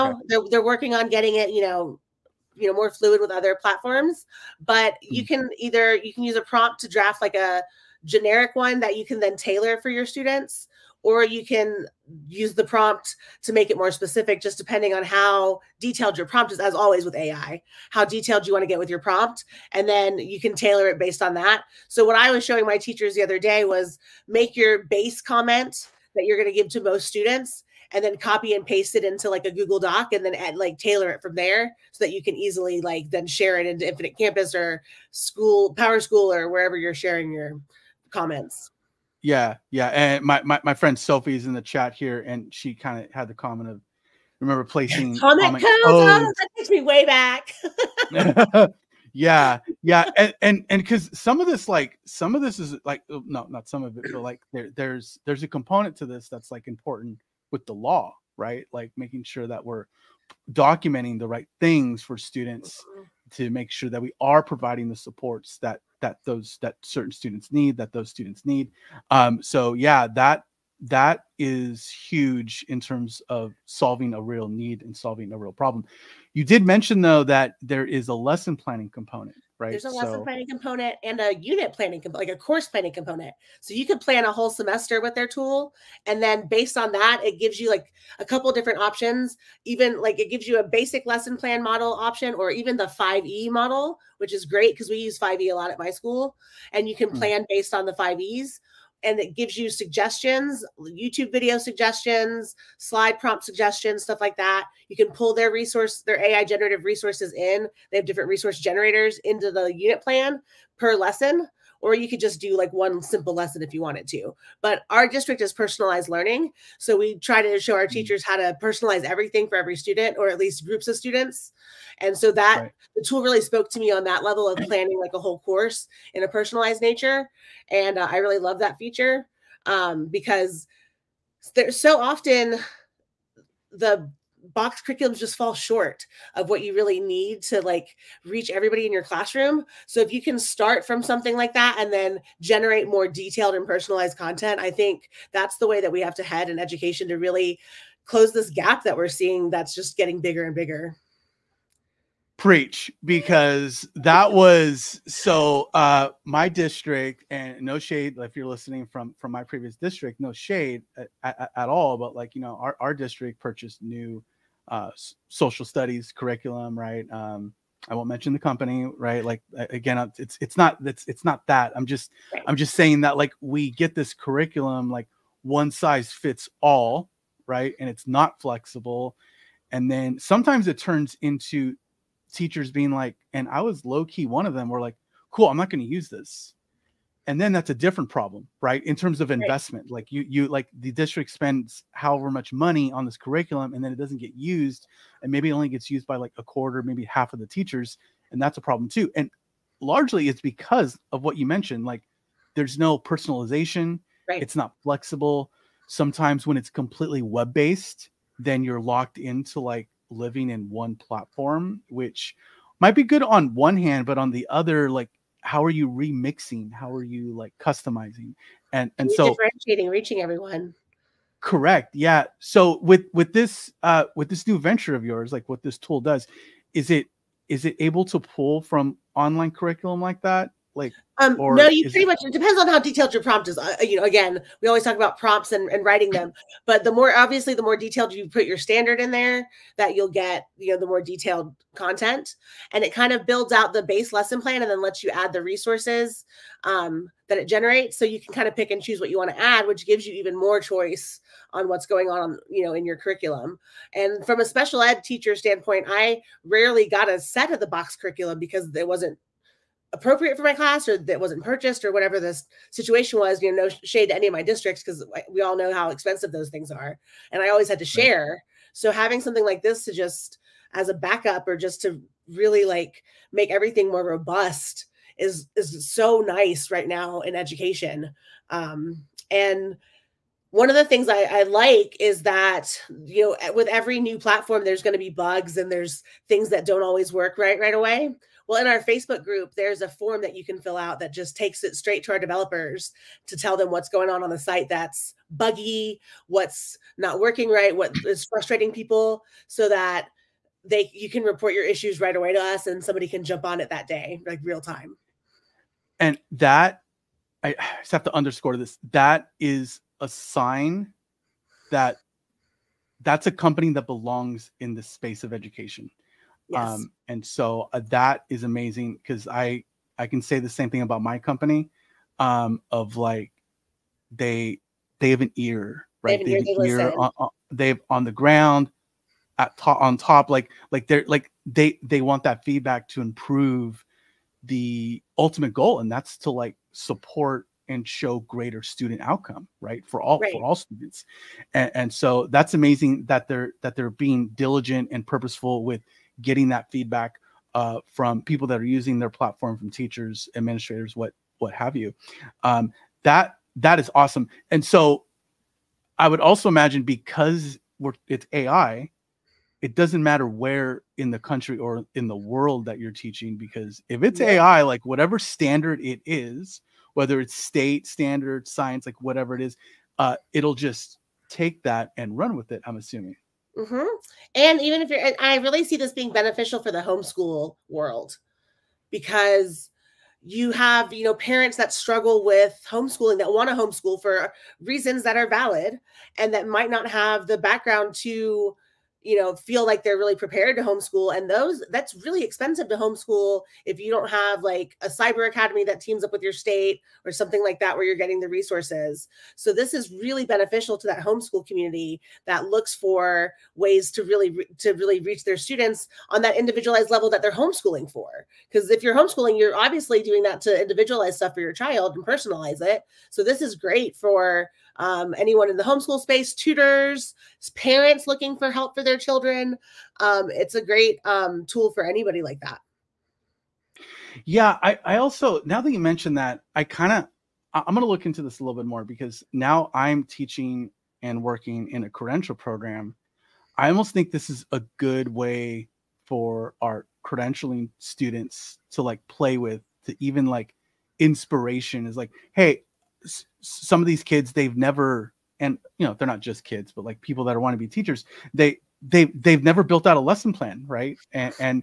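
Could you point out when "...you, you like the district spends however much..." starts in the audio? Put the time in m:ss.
3:10.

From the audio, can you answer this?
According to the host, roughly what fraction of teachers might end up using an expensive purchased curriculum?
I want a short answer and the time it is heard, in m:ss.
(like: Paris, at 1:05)
a quarter, at 3:16.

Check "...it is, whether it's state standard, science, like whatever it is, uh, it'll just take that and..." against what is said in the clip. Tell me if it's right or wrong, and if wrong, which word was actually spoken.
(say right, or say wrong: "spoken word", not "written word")
right.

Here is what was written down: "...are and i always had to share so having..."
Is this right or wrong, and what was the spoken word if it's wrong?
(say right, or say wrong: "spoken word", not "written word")
right.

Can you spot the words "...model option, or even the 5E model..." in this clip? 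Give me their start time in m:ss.
1:31.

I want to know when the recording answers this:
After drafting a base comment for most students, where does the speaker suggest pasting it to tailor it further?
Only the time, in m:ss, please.
0:29.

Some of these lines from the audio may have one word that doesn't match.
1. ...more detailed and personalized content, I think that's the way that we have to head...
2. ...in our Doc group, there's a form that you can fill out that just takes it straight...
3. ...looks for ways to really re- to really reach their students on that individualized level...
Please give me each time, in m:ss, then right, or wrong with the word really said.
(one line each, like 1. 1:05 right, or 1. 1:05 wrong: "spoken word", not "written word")
1. 2:22 right
2. 4:48 wrong: "Facebook", not "Doc"
3. 6:42 right.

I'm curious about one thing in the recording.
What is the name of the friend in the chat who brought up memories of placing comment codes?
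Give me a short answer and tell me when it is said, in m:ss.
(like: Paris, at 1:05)
Sophie, at 0:40.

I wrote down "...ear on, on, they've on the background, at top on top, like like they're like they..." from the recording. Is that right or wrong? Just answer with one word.
wrong.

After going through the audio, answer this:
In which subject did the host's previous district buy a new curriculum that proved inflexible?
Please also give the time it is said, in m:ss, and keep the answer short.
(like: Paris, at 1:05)
social studies, at 2:45.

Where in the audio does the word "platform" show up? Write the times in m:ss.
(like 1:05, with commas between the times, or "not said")
0:03, 3:30, 4:44, 5:49.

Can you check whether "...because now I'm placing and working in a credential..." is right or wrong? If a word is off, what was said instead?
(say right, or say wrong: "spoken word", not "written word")
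wrong: "teaching", not "placing".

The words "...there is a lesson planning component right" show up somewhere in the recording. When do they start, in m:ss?
1:17.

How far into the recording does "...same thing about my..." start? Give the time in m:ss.
5:20.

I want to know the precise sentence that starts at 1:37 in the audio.
plan based on the 5Es and it gives you suggestions, YouTube video suggestions, slide prompt suggestions, stuff like that.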